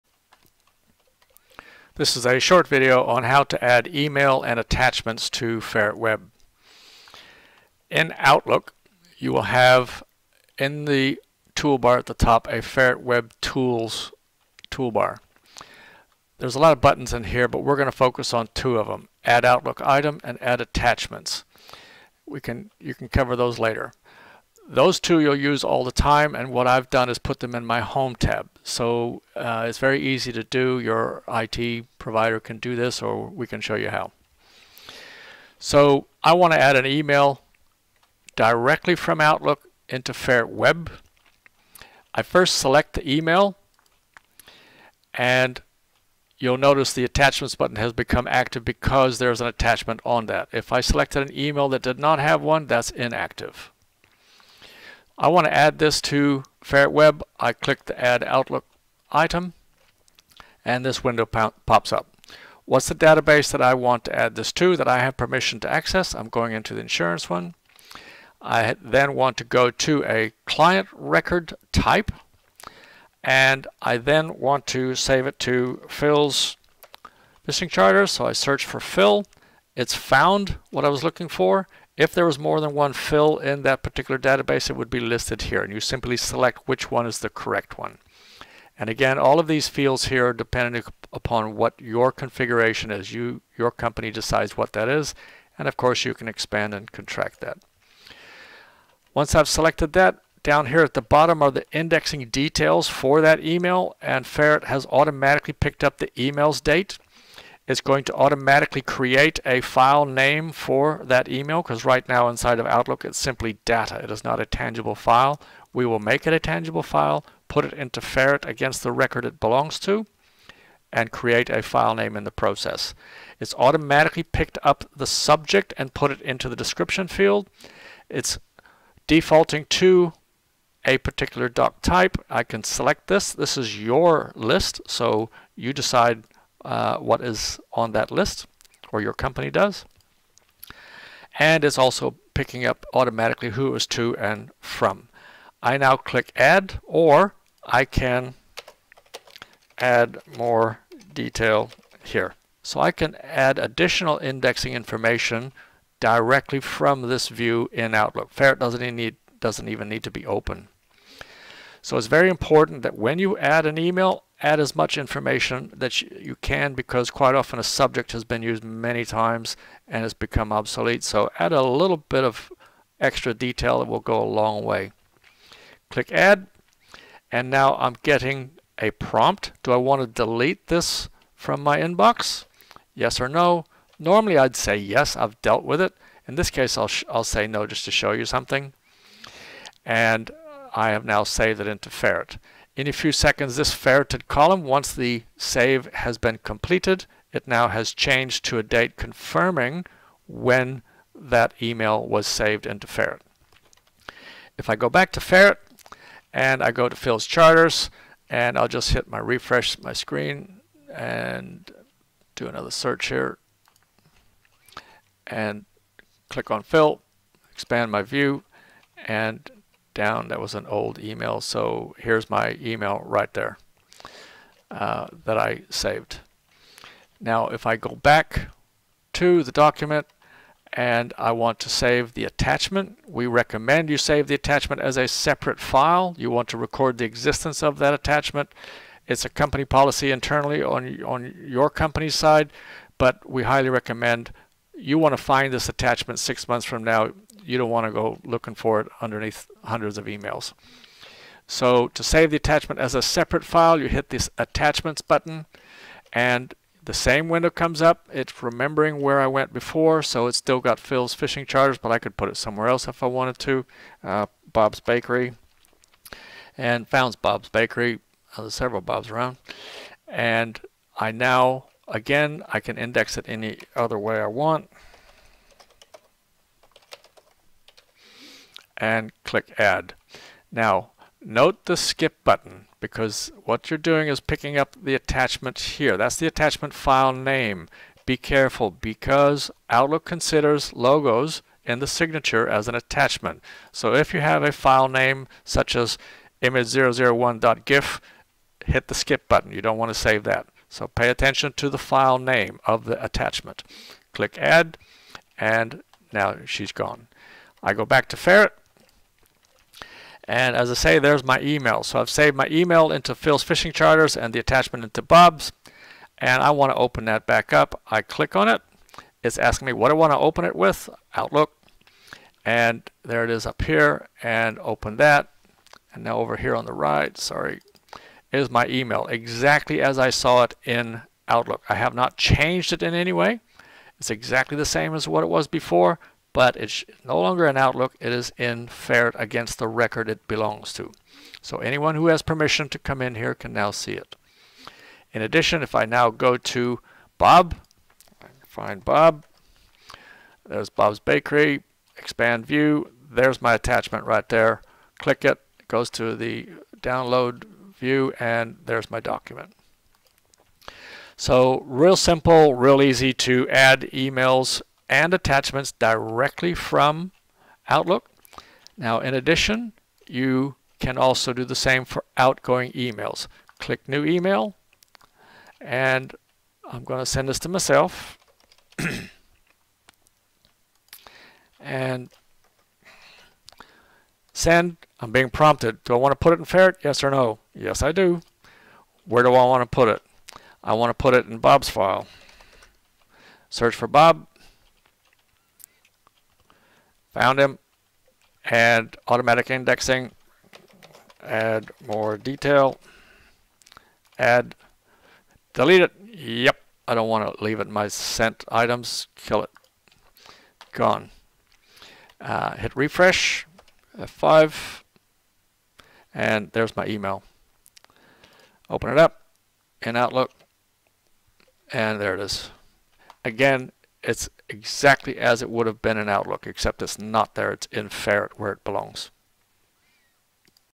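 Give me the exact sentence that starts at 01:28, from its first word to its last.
And again, all of these fields here are dependent upon what your configuration is.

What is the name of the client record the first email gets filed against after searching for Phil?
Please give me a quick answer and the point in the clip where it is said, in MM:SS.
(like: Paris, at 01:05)
Phil's fishing charter, at 01:15.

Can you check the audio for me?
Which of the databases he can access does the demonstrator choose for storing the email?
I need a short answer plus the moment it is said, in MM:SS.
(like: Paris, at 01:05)
Insurance, at 01:06.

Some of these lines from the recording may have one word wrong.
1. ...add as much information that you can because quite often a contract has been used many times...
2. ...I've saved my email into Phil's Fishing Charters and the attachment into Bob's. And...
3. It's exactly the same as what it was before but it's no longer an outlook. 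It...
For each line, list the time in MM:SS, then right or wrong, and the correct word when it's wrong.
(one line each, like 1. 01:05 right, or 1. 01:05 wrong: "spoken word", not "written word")
1. 02:44 wrong: "subject", not "contract"
2. 05:11 right
3. 05:33 right.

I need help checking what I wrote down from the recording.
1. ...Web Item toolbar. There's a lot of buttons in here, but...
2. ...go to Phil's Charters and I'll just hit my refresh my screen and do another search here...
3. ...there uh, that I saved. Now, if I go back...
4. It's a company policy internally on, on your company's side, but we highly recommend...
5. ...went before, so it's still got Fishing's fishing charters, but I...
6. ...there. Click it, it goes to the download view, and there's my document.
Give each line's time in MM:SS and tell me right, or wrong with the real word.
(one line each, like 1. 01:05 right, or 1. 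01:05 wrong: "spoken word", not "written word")
1. 00:13 wrong: "Tools", not "Item"
2. 03:26 right
3. 03:43 right
4. 03:59 right
5. 04:19 wrong: "Phil", not "Fishing"
6. 05:54 right.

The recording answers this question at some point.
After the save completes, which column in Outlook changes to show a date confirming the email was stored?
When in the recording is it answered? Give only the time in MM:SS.
03:13.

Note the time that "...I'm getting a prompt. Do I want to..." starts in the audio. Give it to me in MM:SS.
02:57.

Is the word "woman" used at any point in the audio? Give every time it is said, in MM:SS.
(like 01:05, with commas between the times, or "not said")
not said.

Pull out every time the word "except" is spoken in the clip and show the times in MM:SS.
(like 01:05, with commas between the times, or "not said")
07:06.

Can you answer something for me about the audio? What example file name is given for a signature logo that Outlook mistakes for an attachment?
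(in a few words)
image001.gif.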